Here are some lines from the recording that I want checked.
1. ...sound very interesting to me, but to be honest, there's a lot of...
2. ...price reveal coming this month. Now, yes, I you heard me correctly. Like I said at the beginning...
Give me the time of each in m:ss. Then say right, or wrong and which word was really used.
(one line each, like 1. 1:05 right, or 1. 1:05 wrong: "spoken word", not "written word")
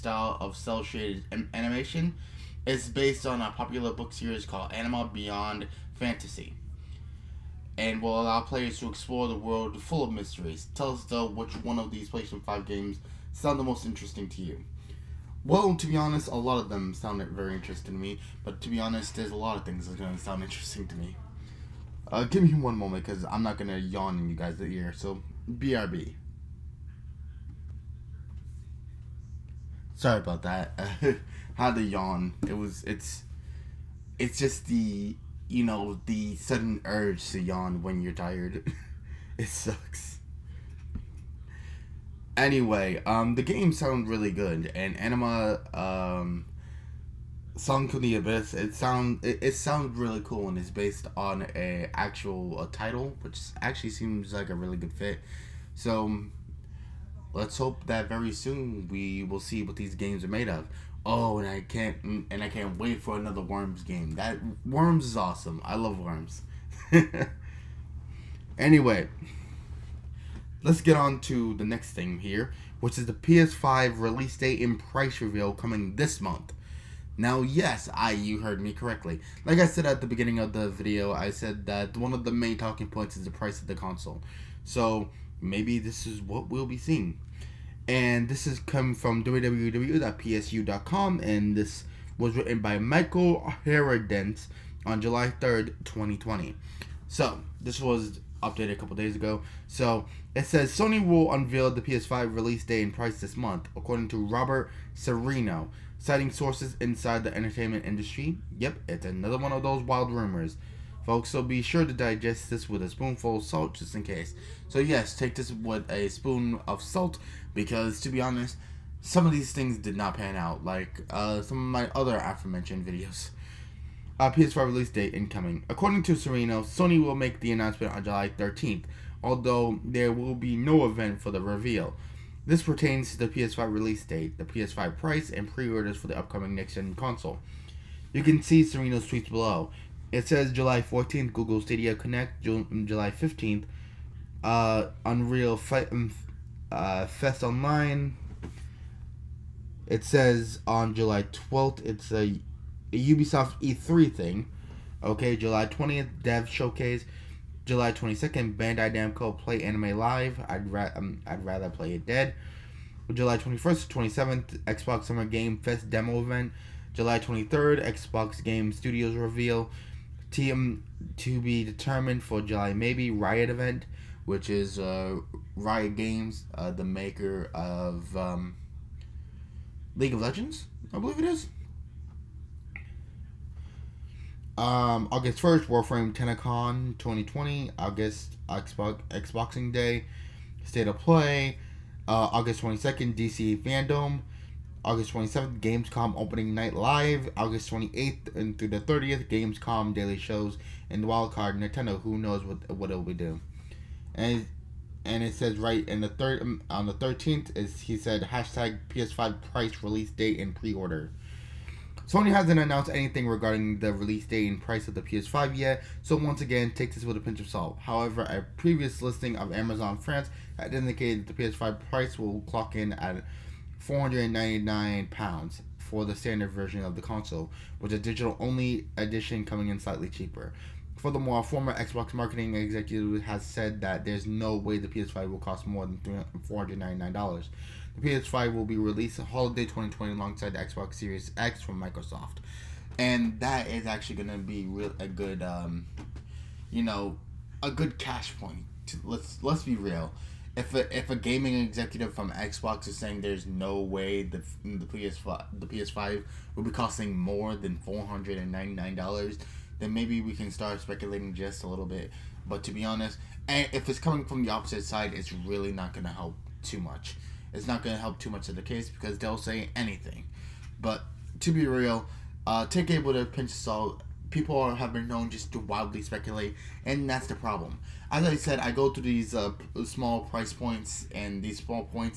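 1. 0:16 right
2. 1:14 right.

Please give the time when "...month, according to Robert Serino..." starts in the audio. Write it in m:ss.
1:43.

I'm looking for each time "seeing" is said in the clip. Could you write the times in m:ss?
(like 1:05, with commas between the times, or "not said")
1:26.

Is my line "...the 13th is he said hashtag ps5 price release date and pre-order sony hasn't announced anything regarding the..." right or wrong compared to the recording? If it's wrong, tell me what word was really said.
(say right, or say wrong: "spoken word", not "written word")
right.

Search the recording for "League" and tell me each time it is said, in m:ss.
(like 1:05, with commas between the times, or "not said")
2:59.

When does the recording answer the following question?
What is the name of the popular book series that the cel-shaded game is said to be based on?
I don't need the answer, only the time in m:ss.
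0:04.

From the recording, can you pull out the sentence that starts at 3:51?
Furthermore, a former Xbox marketing executive has said that there's no way the PS5 will cost more than $499.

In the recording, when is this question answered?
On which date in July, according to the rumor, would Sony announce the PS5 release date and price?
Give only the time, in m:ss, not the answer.
2:08.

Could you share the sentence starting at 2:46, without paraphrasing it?
July 23rd, Xbox Game Studios reveal.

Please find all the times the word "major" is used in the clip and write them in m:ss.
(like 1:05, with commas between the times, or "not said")
not said.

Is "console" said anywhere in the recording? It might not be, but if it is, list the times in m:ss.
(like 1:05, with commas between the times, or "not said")
1:23, 2:16, 3:47.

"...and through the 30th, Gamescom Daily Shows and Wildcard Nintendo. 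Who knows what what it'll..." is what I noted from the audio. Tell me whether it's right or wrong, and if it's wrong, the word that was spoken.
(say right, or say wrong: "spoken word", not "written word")
right.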